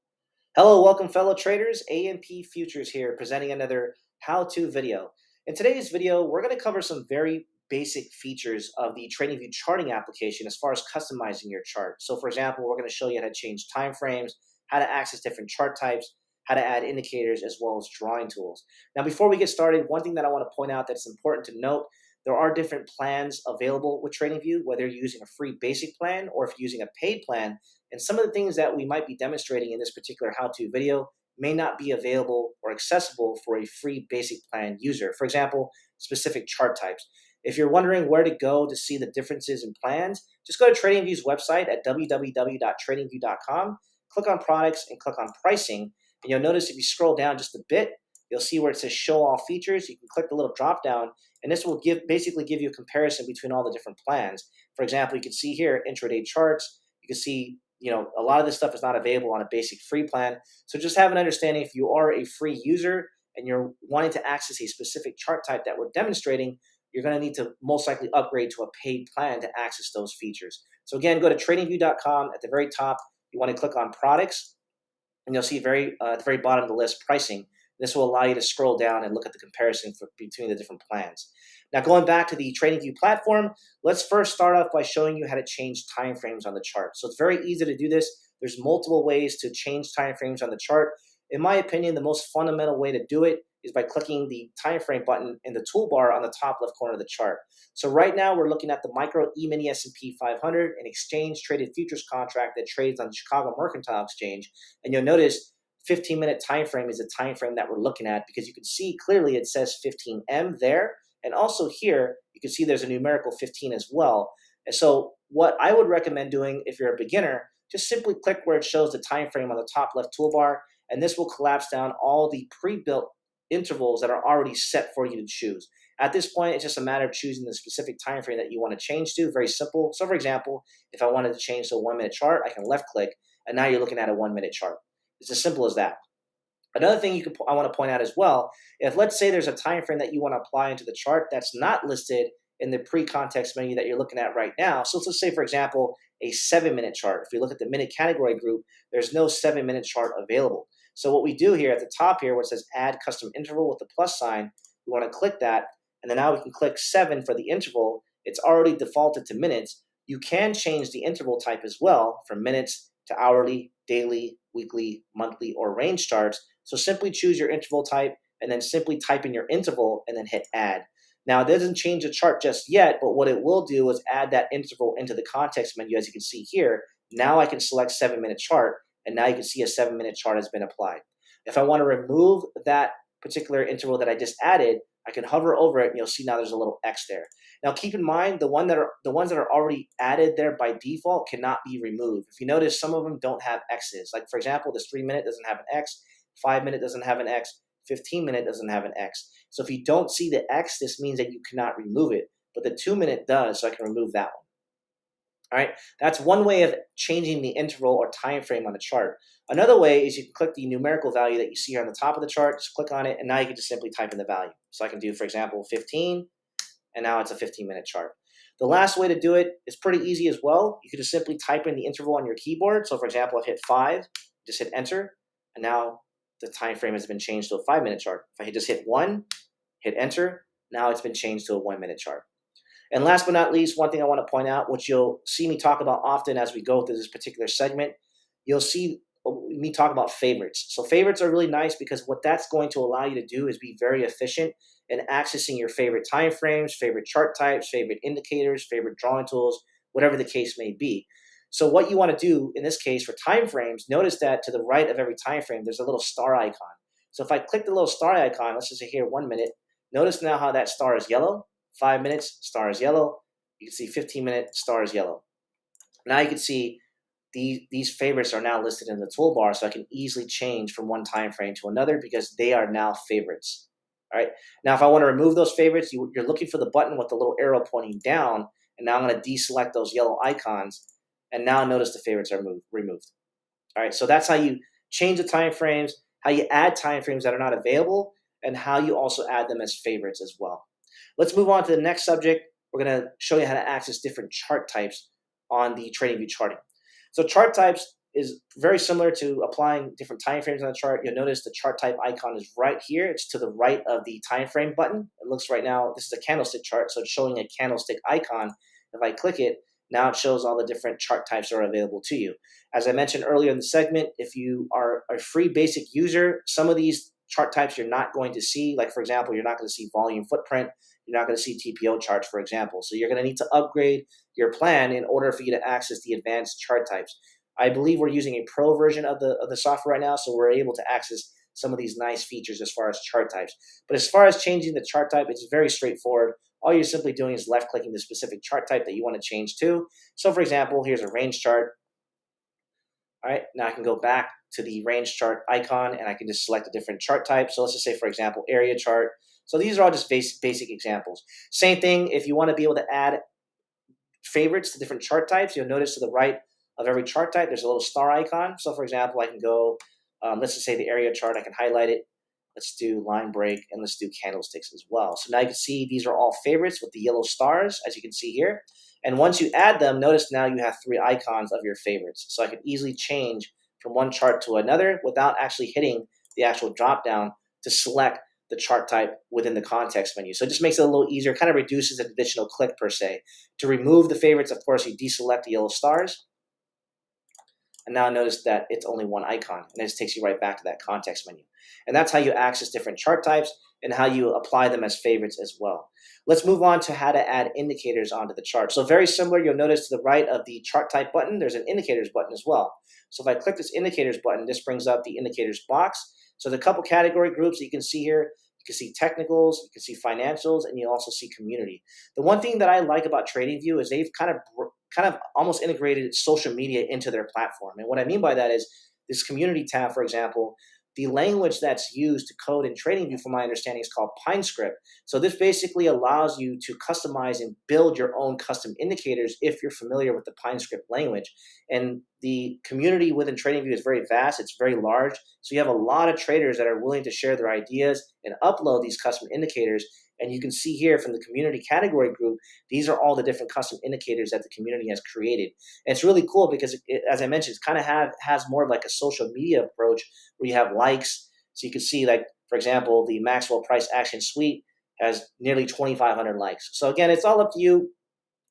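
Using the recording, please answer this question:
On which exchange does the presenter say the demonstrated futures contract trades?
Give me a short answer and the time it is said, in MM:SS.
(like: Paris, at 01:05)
Chicago Mercantile Exchange, at 01:43.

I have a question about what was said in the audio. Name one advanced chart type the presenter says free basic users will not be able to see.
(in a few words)
Volume footprint.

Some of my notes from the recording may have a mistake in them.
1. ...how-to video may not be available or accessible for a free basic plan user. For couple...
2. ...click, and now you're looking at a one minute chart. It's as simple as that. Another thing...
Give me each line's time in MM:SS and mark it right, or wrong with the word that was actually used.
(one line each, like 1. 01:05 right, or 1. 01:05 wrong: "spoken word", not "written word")
1. 00:30 wrong: "example", not "couple"
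2. 02:12 right.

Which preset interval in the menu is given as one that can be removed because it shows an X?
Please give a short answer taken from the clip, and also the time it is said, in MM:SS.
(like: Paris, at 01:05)
2 minute, at 03:22.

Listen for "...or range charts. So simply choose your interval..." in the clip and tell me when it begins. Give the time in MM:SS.
02:45.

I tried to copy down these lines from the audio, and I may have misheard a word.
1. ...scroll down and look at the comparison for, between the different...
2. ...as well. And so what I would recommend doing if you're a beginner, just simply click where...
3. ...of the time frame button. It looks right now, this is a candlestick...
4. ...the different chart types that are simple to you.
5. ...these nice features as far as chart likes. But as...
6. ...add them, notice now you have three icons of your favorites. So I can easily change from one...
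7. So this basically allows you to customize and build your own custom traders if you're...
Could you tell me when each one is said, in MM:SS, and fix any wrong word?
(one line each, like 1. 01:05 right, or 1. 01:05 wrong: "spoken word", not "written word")
1. 01:18 right
2. 01:53 right
3. 05:03 right
4. 05:10 wrong: "available", not "simple"
5. 05:31 wrong: "types", not "likes"
6. 06:09 right
7. 07:05 wrong: "indicators", not "traders".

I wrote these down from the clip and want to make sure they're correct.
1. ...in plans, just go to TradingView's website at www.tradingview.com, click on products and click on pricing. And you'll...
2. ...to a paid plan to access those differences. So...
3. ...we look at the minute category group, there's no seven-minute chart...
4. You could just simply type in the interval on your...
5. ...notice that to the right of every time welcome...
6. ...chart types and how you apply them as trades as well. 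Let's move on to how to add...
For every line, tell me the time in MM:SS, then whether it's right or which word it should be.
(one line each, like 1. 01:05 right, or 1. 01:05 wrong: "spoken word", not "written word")
1. 00:39 right
2. 01:08 wrong: "features", not "differences"
3. 02:27 right
4. 03:40 right
5. 04:13 wrong: "frame", not "welcome"
6. 06:32 wrong: "favorites", not "trades".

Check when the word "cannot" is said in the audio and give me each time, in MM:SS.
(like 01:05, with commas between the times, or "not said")
03:11, 03:21.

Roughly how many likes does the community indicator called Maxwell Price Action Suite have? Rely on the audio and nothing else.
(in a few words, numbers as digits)
2,500.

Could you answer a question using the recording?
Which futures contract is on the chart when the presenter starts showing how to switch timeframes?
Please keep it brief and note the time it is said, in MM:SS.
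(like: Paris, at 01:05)
Micro E-mini S&P 500, at 01:38.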